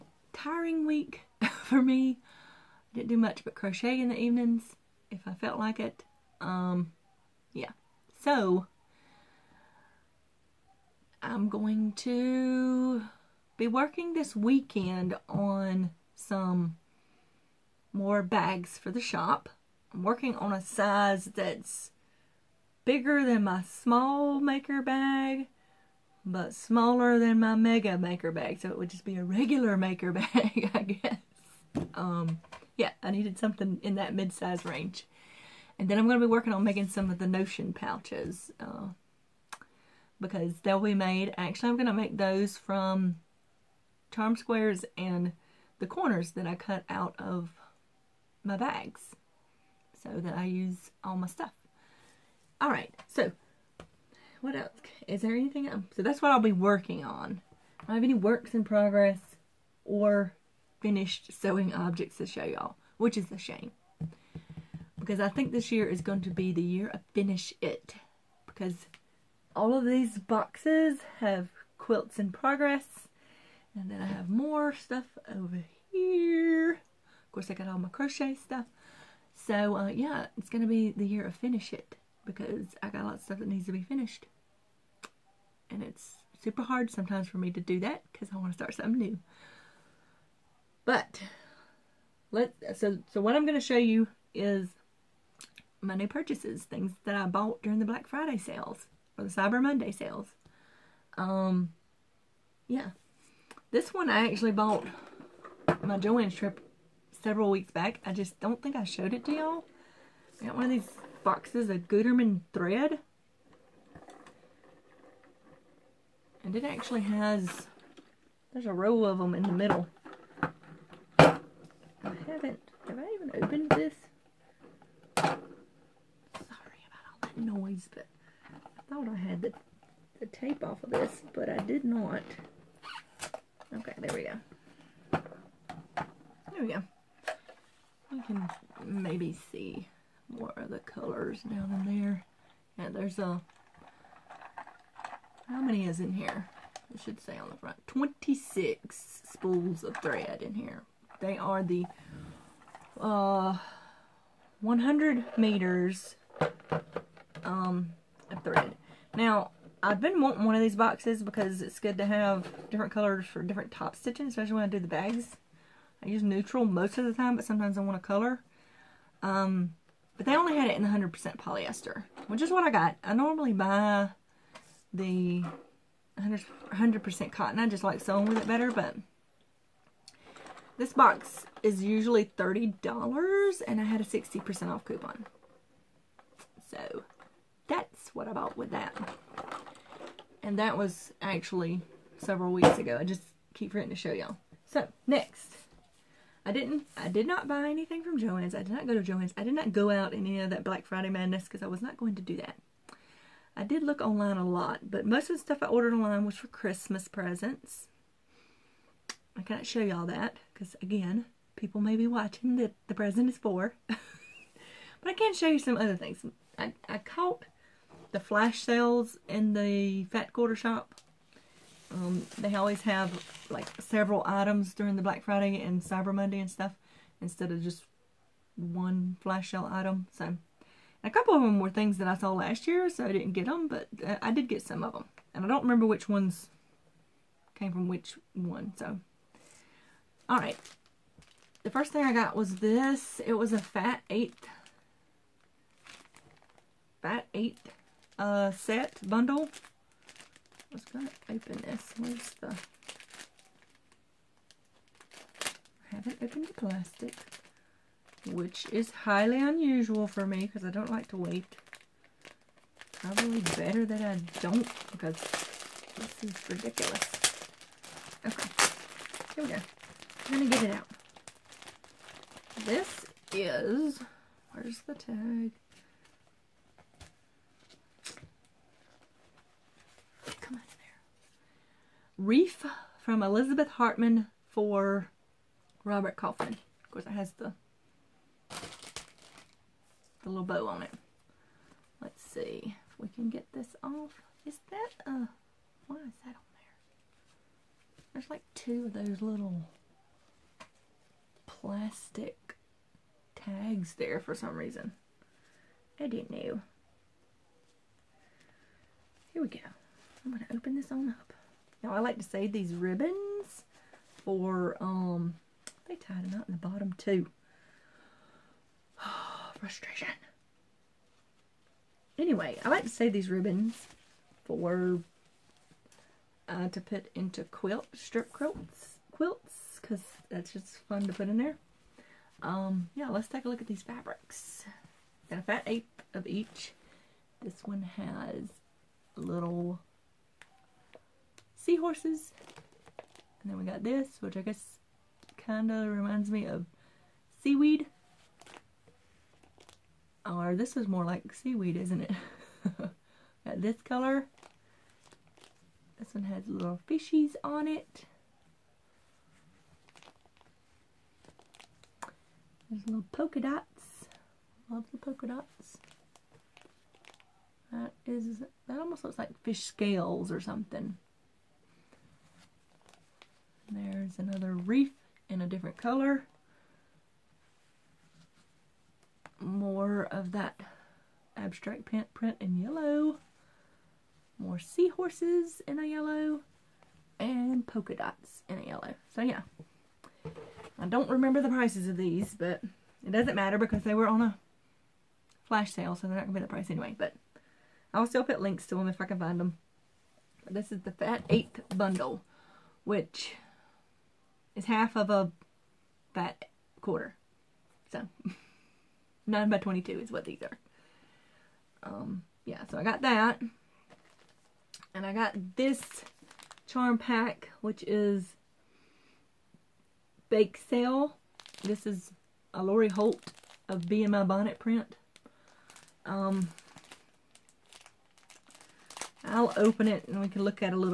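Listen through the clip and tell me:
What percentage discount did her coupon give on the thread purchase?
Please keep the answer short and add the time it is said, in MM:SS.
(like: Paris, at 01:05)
60%, at 03:04.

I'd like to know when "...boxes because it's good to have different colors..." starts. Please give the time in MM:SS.
02:40.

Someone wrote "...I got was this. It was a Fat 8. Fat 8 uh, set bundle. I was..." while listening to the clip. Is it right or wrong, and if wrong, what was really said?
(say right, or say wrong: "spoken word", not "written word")
right.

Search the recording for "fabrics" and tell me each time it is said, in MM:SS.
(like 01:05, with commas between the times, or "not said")
05:33.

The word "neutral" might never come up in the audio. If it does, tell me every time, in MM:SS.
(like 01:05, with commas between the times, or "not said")
02:46.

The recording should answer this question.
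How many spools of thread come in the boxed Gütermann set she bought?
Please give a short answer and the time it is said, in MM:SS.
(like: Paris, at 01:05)
26, at 02:27.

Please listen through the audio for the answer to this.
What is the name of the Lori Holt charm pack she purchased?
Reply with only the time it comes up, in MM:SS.
07:00.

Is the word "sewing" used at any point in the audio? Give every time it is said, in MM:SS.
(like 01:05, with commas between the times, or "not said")
01:01, 02:57.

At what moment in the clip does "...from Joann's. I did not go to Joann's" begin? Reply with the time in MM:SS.
03:18.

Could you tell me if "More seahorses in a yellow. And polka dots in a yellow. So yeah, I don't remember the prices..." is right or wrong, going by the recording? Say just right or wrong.
right.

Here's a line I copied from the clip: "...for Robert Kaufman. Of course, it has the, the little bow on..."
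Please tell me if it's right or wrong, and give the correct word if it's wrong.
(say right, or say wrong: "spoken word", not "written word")
right.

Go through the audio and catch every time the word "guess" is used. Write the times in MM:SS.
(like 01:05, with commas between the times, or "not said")
00:30, 05:44.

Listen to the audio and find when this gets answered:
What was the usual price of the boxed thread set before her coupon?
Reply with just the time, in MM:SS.
03:02.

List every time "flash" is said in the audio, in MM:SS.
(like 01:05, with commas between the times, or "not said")
03:38, 03:49, 06:35.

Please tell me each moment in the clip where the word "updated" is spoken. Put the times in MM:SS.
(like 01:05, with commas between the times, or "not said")
not said.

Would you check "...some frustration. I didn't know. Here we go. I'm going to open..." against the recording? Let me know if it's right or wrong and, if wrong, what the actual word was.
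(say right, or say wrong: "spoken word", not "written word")
wrong: "reason", not "frustration".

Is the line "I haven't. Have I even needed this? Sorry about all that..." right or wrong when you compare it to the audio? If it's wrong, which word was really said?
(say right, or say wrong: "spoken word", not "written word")
wrong: "opened", not "needed".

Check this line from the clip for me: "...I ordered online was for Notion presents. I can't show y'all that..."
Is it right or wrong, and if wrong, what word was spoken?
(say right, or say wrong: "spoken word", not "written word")
wrong: "Christmas", not "Notion".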